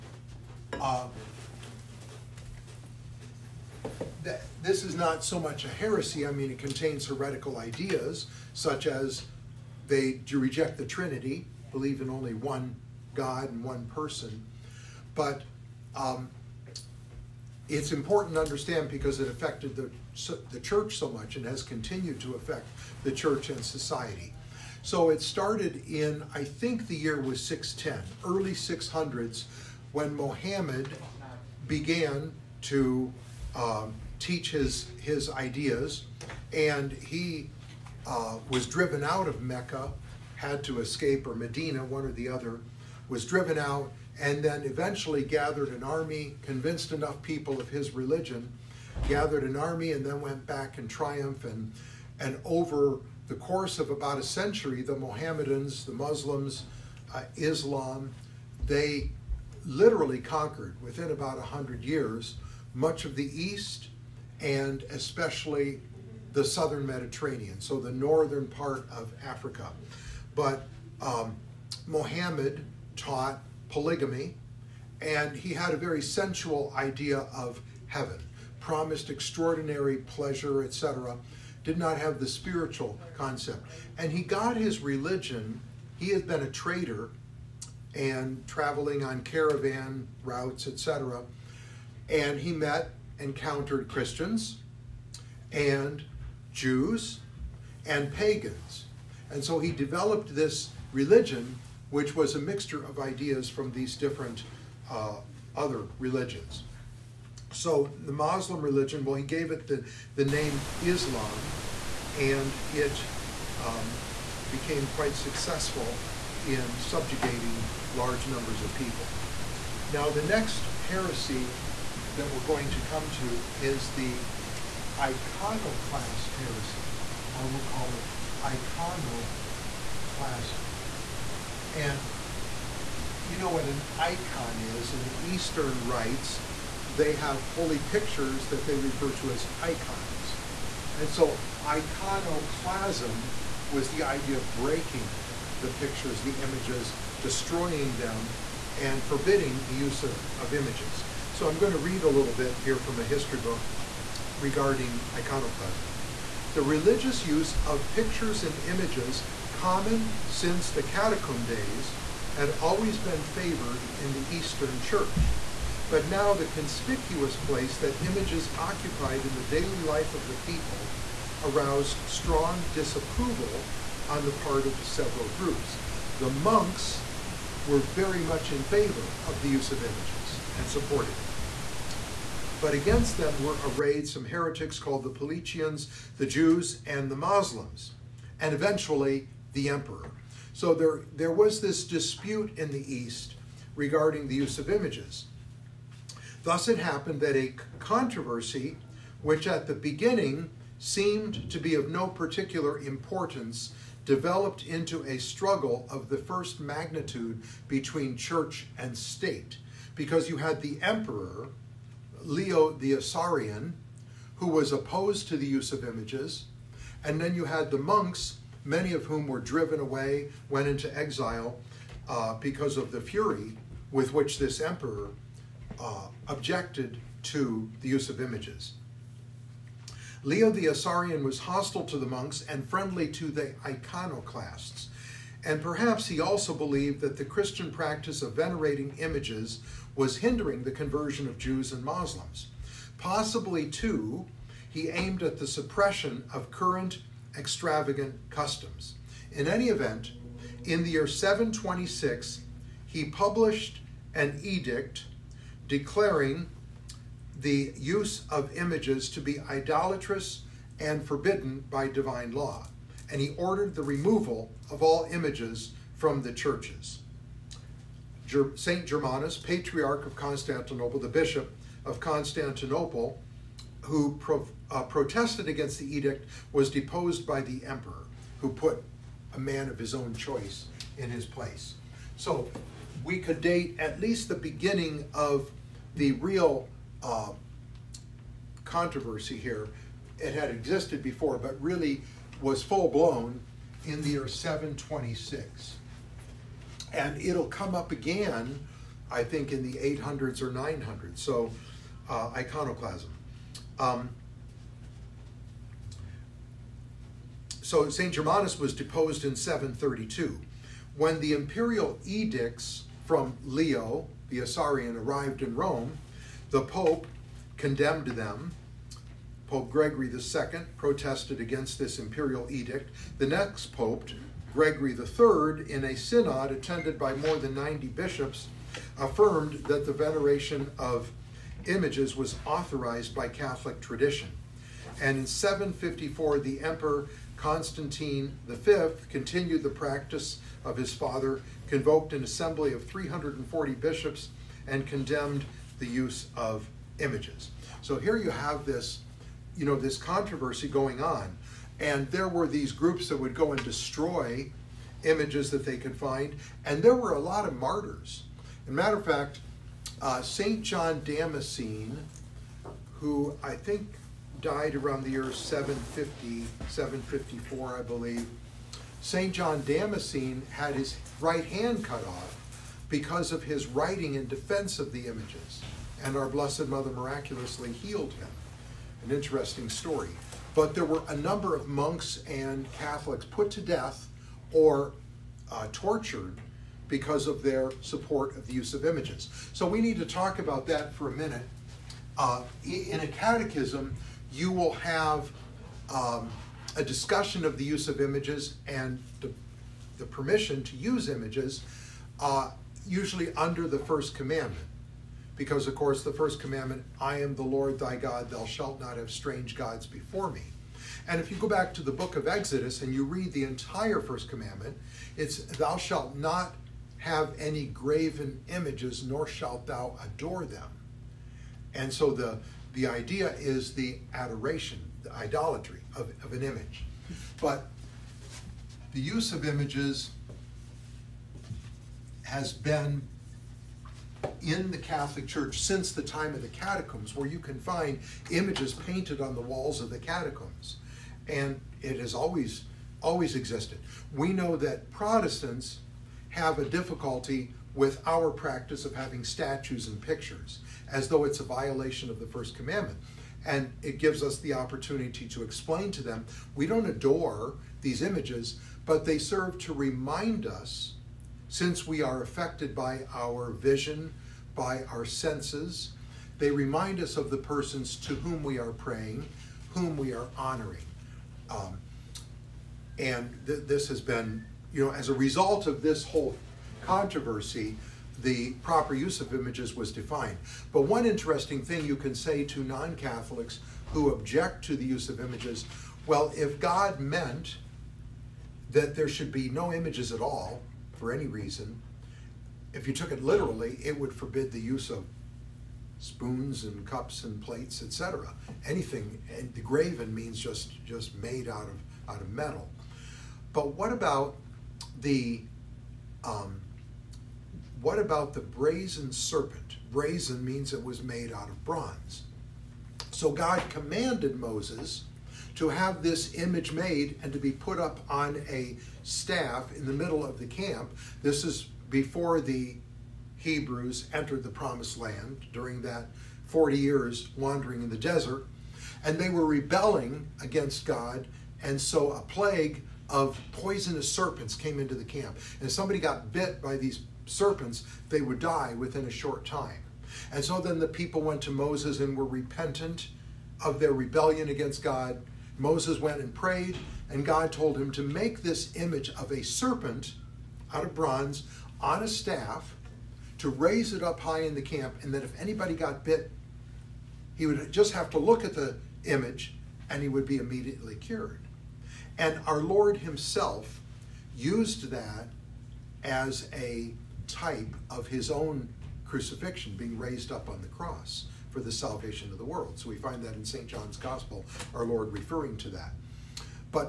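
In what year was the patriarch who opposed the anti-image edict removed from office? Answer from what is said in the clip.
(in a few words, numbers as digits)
732.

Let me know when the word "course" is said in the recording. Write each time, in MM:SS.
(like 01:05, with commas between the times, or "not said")
00:53, 06:45.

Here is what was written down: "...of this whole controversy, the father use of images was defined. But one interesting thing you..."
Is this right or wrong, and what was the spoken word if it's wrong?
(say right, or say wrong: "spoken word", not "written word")
wrong: "proper", not "father".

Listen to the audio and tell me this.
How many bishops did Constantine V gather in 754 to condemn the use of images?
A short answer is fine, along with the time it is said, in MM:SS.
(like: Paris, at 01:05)
340, at 05:42.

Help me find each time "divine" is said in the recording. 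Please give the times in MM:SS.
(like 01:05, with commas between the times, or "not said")
04:21.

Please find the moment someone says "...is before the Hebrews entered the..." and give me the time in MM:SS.
08:41.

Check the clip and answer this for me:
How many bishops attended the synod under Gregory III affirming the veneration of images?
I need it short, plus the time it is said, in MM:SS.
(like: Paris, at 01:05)
More than 90, at 05:27.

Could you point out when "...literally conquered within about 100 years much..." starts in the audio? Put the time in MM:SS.
00:59.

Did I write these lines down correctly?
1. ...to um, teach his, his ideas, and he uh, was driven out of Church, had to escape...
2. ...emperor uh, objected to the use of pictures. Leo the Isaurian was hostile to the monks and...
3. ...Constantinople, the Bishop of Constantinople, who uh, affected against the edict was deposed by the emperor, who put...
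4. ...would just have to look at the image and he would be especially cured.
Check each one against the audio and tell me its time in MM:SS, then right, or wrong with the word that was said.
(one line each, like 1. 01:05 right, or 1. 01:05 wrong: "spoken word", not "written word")
1. 00:32 wrong: "Mecca", not "Church"
2. 03:44 wrong: "images", not "pictures"
3. 04:30 wrong: "protested", not "affected"
4. 09:17 wrong: "immediately", not "especially".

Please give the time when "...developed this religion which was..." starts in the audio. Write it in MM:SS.
01:39.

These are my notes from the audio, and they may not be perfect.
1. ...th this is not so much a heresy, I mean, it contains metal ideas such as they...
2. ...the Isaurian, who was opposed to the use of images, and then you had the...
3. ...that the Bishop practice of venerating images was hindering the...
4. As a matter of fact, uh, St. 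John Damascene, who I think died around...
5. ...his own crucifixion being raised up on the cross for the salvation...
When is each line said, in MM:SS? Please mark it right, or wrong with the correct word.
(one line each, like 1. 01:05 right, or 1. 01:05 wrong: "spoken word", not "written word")
1. 00:04 wrong: "heretical", not "metal"
2. 03:32 right
3. 03:57 wrong: "Christian", not "Bishop"
4. 05:58 right
5. 09:28 right.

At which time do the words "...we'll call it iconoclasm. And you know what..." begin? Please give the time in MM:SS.
02:07.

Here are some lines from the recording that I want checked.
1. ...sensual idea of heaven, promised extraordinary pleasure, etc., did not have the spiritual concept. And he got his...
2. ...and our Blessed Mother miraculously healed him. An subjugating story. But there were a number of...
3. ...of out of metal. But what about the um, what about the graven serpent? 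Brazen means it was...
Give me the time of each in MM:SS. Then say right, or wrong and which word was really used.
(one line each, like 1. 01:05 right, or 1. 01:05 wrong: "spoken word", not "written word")
1. 01:16 right
2. 06:16 wrong: "interesting", not "subjugating"
3. 08:21 wrong: "brazen", not "graven".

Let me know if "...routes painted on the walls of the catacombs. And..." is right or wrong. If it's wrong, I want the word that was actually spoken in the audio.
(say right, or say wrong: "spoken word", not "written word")
wrong: "images", not "routes".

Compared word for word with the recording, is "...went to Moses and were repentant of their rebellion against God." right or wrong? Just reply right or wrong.
right.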